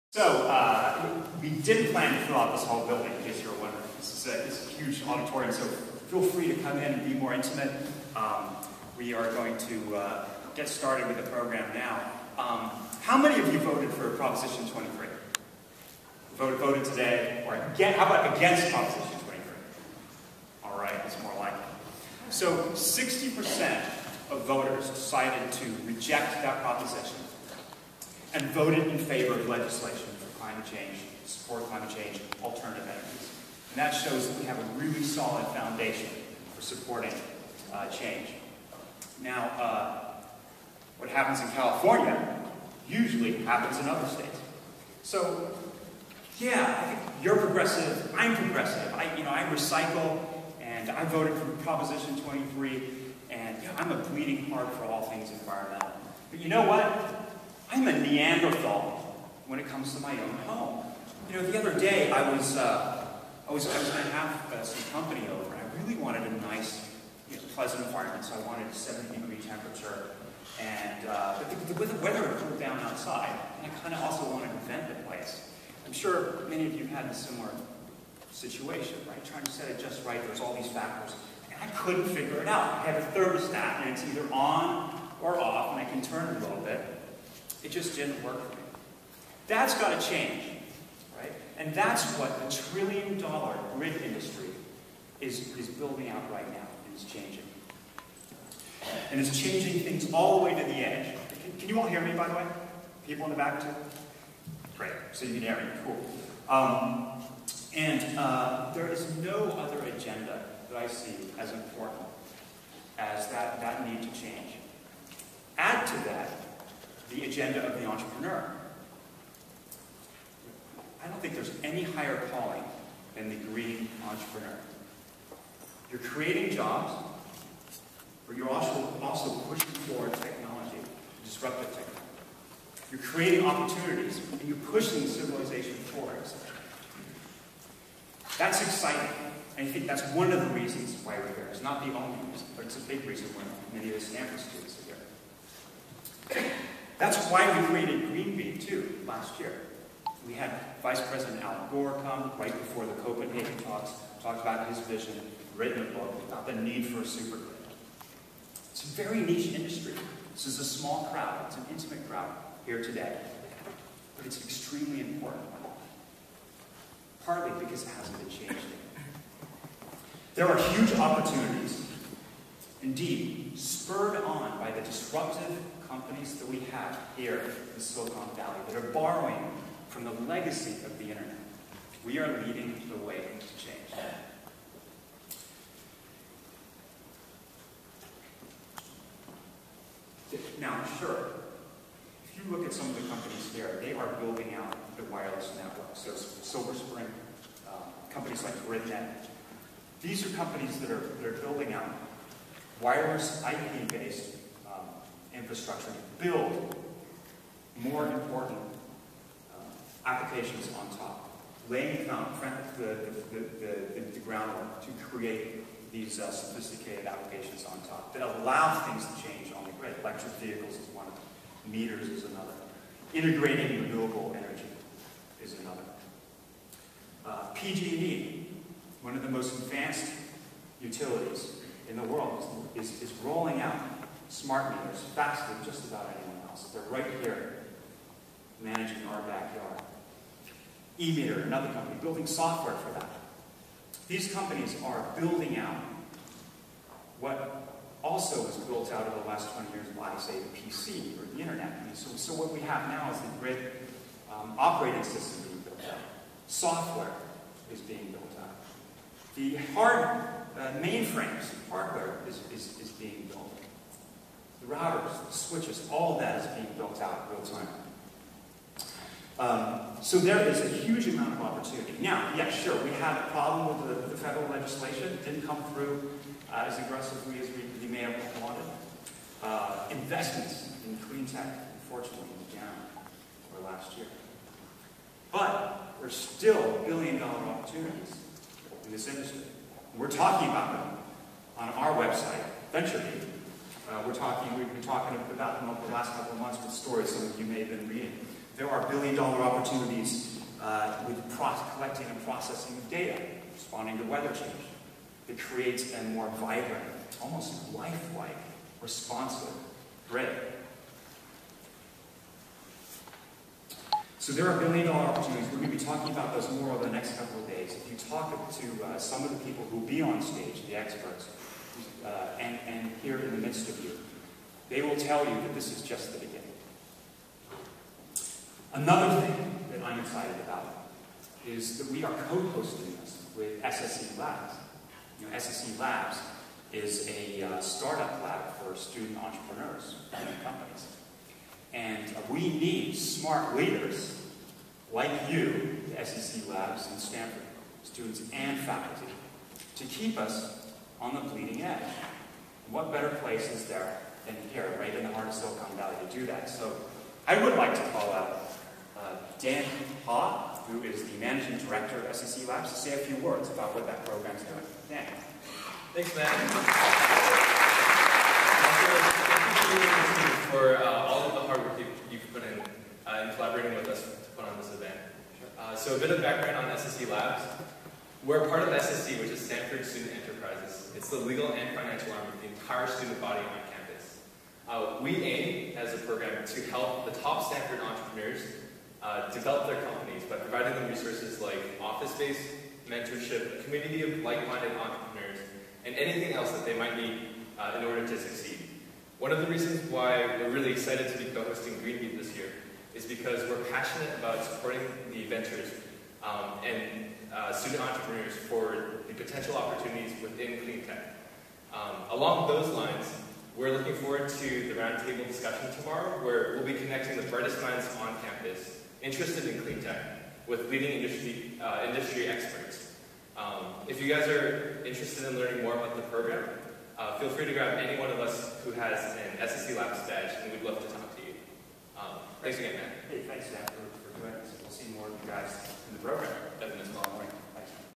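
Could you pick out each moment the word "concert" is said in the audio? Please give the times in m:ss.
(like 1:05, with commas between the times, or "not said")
not said.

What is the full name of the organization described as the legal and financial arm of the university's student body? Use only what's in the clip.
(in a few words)
Stanford Student Enterprises.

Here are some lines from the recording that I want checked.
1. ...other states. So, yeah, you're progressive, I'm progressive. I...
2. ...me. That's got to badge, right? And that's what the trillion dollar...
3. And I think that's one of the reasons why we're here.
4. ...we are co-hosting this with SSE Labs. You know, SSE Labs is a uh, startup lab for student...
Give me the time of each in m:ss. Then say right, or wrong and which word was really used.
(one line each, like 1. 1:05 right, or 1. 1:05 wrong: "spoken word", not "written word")
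1. 0:43 right
2. 1:28 wrong: "change", not "badge"
3. 2:19 right
4. 5:31 right.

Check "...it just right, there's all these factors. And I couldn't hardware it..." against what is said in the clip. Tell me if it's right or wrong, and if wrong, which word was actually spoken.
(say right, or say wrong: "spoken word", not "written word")
wrong: "figure", not "hardware".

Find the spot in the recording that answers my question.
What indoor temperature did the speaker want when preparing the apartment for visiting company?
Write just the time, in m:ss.
1:08.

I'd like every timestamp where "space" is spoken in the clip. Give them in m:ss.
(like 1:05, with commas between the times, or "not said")
6:32.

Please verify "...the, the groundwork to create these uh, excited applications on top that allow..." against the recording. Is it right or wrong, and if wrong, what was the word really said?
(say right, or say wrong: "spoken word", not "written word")
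wrong: "sophisticated", not "excited".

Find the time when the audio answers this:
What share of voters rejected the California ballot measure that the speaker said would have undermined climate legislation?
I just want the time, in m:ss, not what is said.
0:22.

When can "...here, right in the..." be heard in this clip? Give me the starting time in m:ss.
5:54.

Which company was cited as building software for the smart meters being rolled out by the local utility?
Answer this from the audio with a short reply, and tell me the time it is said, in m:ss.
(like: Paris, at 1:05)
eMeter, at 4:00.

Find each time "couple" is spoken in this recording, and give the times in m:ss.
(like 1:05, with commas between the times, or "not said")
4:56, 5:17.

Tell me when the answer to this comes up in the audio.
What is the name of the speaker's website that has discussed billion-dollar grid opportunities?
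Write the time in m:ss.
4:52.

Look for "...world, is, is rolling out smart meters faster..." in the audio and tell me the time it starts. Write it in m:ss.
3:52.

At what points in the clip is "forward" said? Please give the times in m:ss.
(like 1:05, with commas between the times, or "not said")
2:09, 2:15, 6:53.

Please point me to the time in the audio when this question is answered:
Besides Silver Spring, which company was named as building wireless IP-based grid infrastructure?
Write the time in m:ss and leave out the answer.
3:18.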